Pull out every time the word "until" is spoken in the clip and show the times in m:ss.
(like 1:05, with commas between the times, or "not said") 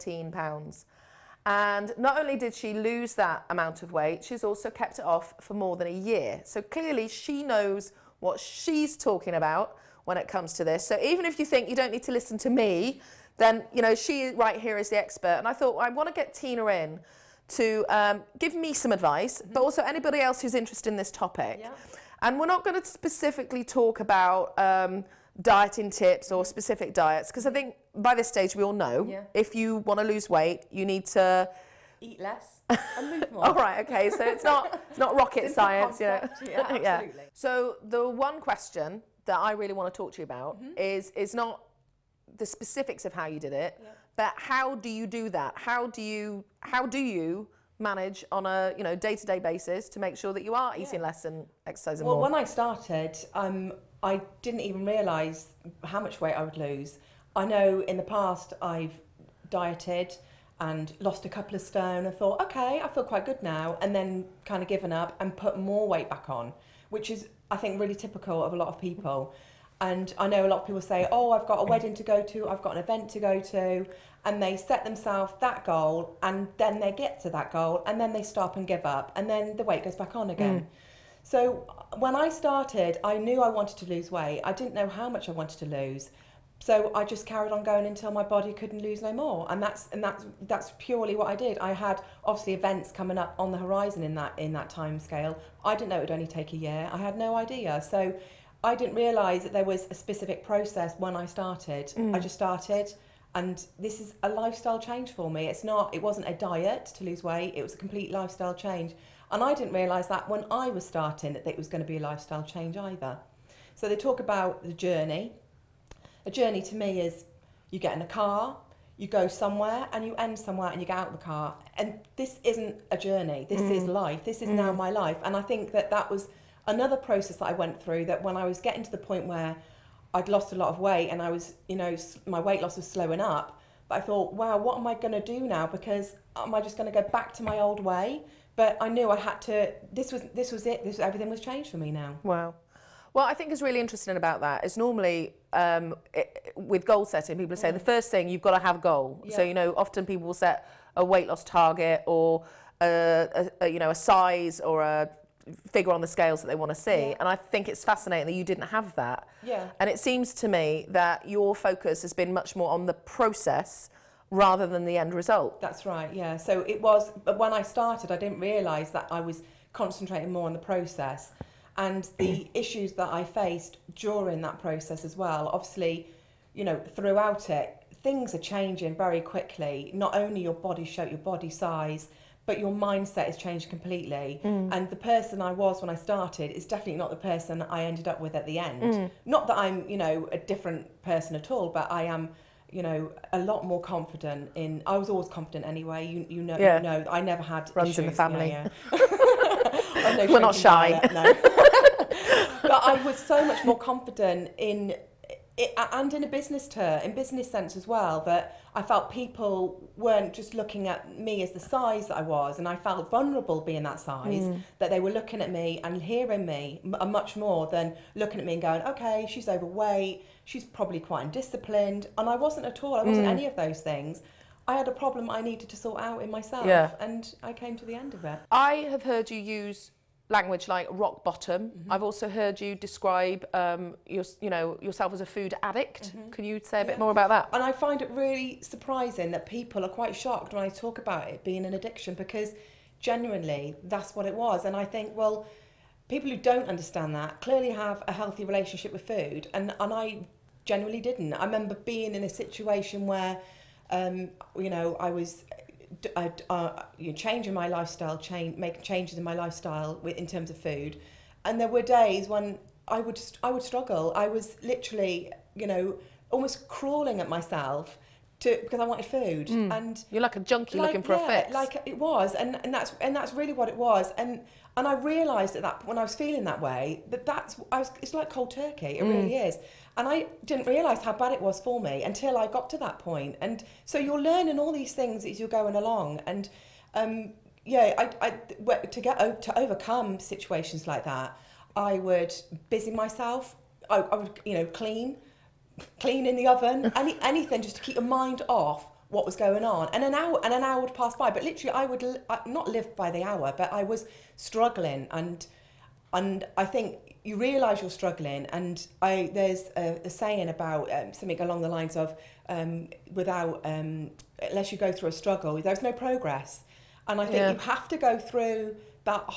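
1:27, 4:42.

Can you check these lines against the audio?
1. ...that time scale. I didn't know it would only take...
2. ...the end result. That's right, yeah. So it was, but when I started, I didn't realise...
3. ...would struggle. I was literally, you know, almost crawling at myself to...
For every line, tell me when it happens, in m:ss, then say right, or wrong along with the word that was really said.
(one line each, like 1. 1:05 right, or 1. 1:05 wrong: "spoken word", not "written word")
1. 1:34 right
2. 2:44 right
3. 4:23 right.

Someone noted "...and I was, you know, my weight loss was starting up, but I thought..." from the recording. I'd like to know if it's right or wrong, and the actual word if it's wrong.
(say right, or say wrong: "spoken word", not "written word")
wrong: "slowing", not "starting".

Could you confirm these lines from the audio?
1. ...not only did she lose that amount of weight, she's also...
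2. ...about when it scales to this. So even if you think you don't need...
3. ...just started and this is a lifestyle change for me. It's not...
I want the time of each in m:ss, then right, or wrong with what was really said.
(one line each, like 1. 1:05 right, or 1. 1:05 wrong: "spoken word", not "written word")
1. 0:01 right
2. 0:09 wrong: "comes", not "scales"
3. 1:42 right.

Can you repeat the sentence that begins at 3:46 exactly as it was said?
and I came to the end of it I have heard you use language like rock bottom.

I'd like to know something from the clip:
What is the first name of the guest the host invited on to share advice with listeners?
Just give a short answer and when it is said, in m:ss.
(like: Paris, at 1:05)
Tina, at 0:16.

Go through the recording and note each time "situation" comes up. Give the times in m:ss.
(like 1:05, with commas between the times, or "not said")
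4:12, 4:50.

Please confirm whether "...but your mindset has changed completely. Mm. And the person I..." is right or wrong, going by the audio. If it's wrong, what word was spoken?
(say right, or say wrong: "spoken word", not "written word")
right.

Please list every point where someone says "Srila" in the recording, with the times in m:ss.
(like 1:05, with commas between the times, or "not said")
not said.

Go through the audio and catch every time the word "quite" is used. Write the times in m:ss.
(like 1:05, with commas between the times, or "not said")
1:03, 3:40, 4:00.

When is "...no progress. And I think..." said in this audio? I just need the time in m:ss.
5:15.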